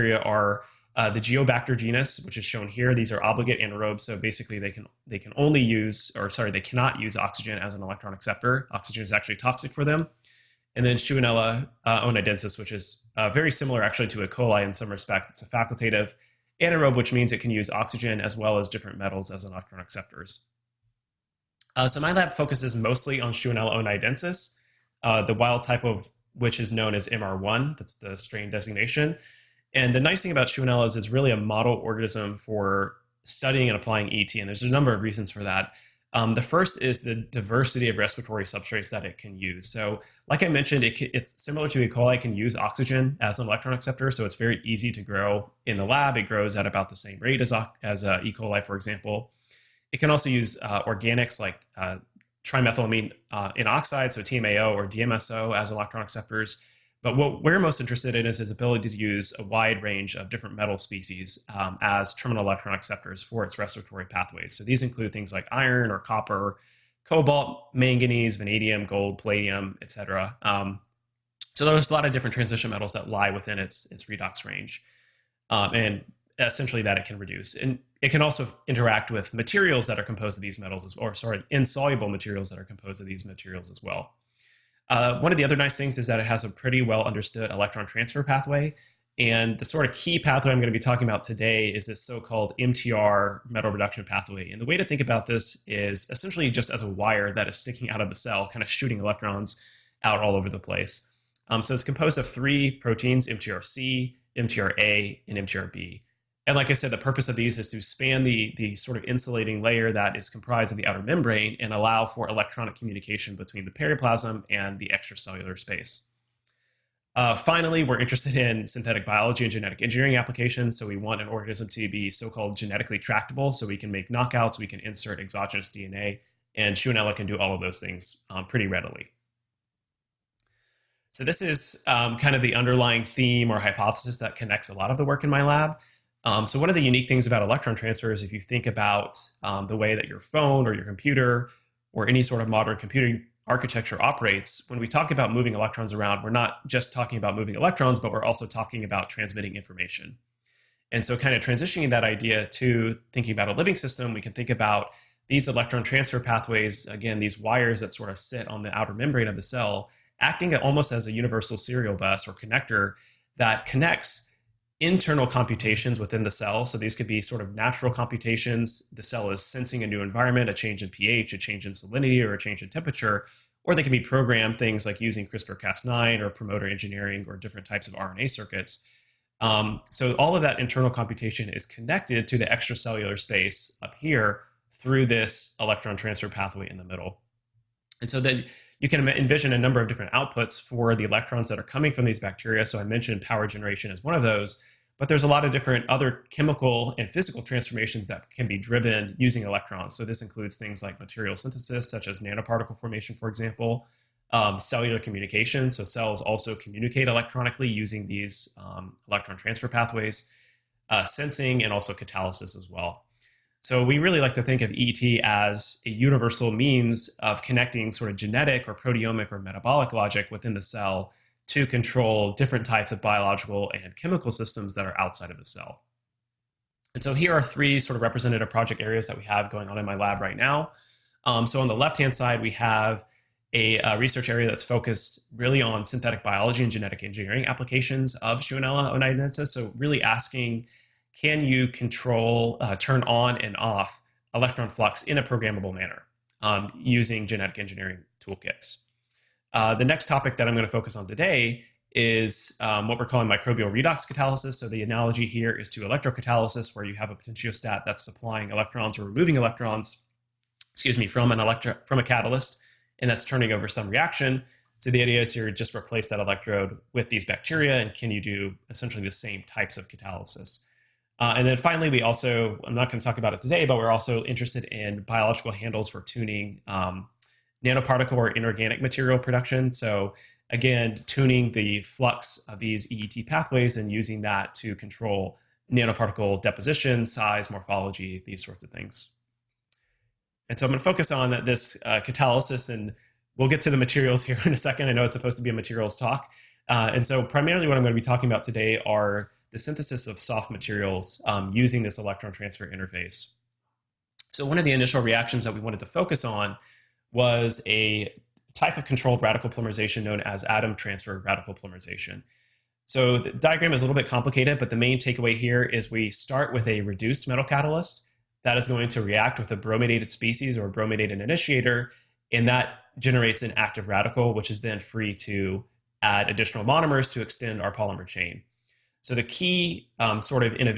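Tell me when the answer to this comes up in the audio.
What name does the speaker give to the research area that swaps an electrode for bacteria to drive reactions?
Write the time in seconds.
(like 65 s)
253 s.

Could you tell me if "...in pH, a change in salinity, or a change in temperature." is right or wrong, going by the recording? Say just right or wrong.
right.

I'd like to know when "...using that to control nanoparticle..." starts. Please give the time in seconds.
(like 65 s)
283 s.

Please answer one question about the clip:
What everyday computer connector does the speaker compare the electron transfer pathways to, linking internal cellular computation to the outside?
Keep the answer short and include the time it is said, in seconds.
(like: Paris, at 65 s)
universal serial bus, at 161 s.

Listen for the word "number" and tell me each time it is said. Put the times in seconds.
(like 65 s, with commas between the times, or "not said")
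34 s, 189 s.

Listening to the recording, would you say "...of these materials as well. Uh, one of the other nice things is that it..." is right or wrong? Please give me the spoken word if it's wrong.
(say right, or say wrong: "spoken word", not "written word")
right.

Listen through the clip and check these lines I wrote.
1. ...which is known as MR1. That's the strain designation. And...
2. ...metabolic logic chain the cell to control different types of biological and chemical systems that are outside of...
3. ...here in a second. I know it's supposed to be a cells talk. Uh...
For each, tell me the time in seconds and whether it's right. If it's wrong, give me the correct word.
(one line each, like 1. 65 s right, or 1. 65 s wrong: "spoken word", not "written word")
1. 26 s right
2. 219 s wrong: "within", not "chain"
3. 294 s wrong: "materials", not "cells".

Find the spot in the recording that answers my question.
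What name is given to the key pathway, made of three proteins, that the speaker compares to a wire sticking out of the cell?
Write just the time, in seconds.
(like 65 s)
92 s.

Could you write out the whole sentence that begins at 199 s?
So this includes things like material synthesis, such as nanoparticle formation, for example, um, cellular communication.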